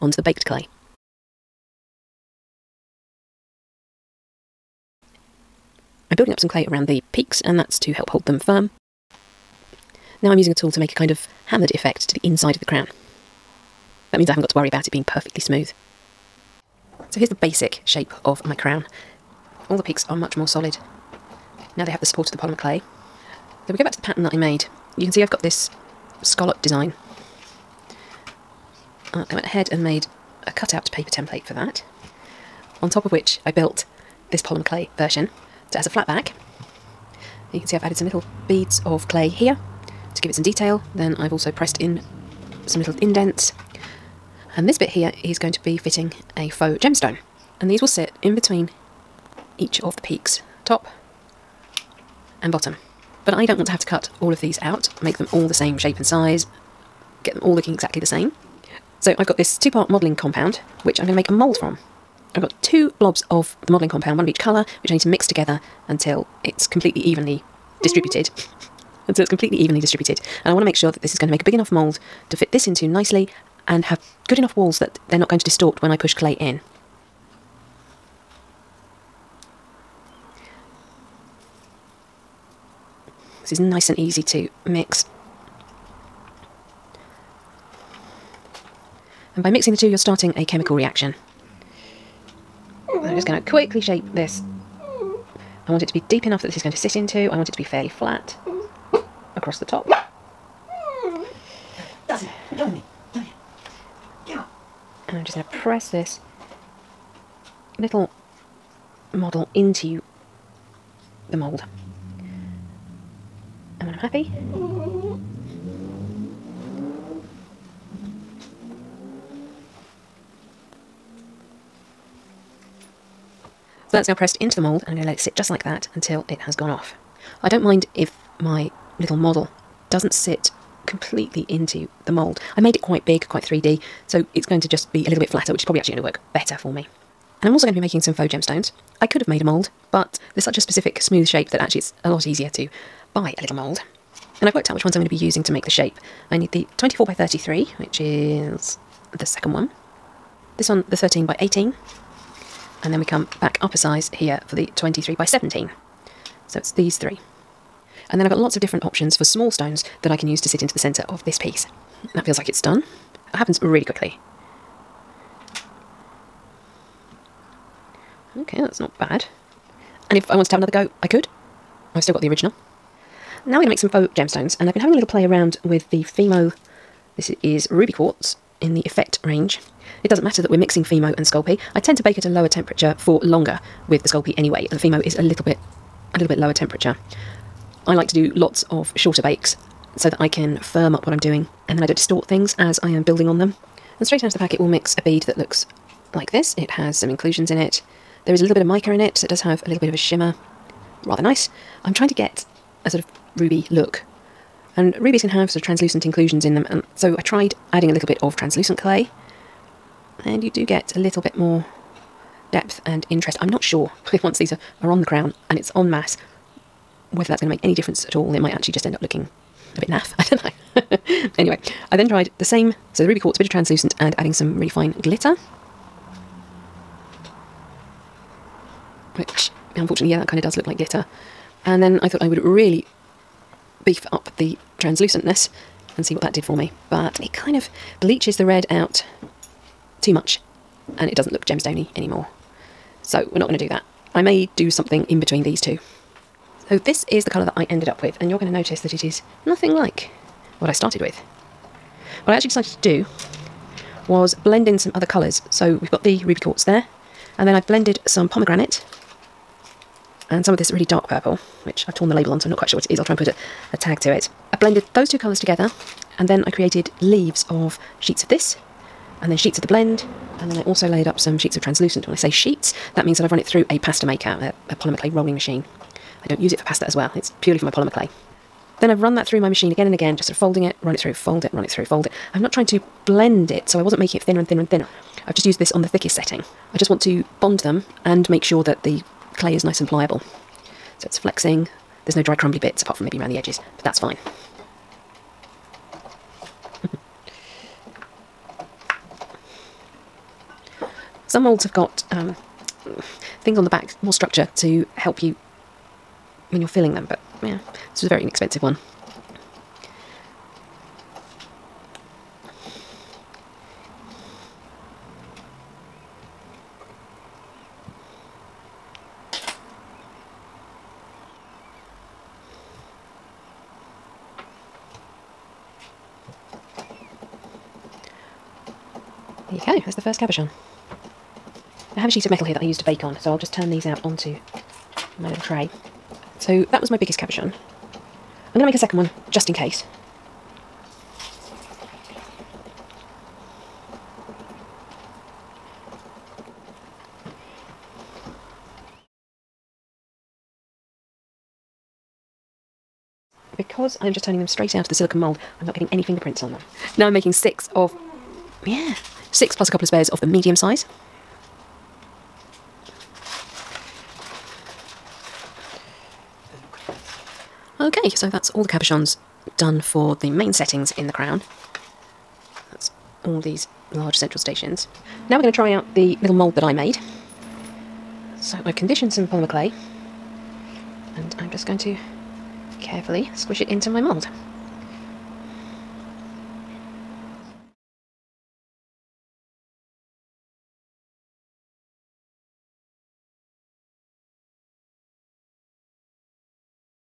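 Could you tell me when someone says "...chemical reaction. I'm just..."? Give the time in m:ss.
1:30.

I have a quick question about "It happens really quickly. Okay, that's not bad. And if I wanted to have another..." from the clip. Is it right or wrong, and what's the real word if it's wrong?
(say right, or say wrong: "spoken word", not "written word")
right.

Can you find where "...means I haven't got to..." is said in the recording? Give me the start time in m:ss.
0:14.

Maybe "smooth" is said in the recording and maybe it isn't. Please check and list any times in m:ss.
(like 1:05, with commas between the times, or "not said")
0:15, 2:21.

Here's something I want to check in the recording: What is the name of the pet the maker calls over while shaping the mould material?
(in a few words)
Dustin.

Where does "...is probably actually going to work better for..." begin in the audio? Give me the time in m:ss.
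2:15.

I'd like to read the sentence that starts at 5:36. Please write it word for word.
So that was my biggest cabochon.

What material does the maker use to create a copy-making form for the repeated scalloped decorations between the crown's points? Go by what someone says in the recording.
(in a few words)
two-part modelling compound.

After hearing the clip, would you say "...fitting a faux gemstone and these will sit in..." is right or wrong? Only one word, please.
right.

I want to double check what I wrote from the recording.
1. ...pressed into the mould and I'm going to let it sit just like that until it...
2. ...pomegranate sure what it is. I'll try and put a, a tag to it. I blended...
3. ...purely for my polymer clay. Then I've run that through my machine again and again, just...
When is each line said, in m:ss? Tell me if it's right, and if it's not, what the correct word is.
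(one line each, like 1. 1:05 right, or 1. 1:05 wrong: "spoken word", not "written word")
1. 2:04 right
2. 4:22 wrong: "quite", not "pomegranate"
3. 4:37 right.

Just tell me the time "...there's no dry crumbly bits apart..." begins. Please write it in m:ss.
4:52.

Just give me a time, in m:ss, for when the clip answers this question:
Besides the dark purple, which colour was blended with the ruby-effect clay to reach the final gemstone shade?
4:18.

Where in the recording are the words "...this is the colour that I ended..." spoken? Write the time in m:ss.
4:06.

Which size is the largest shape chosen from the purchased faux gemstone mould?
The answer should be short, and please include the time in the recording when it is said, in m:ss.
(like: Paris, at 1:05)
24 by 33, at 2:26.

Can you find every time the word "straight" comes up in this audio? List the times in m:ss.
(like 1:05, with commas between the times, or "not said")
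3:14, 5:54.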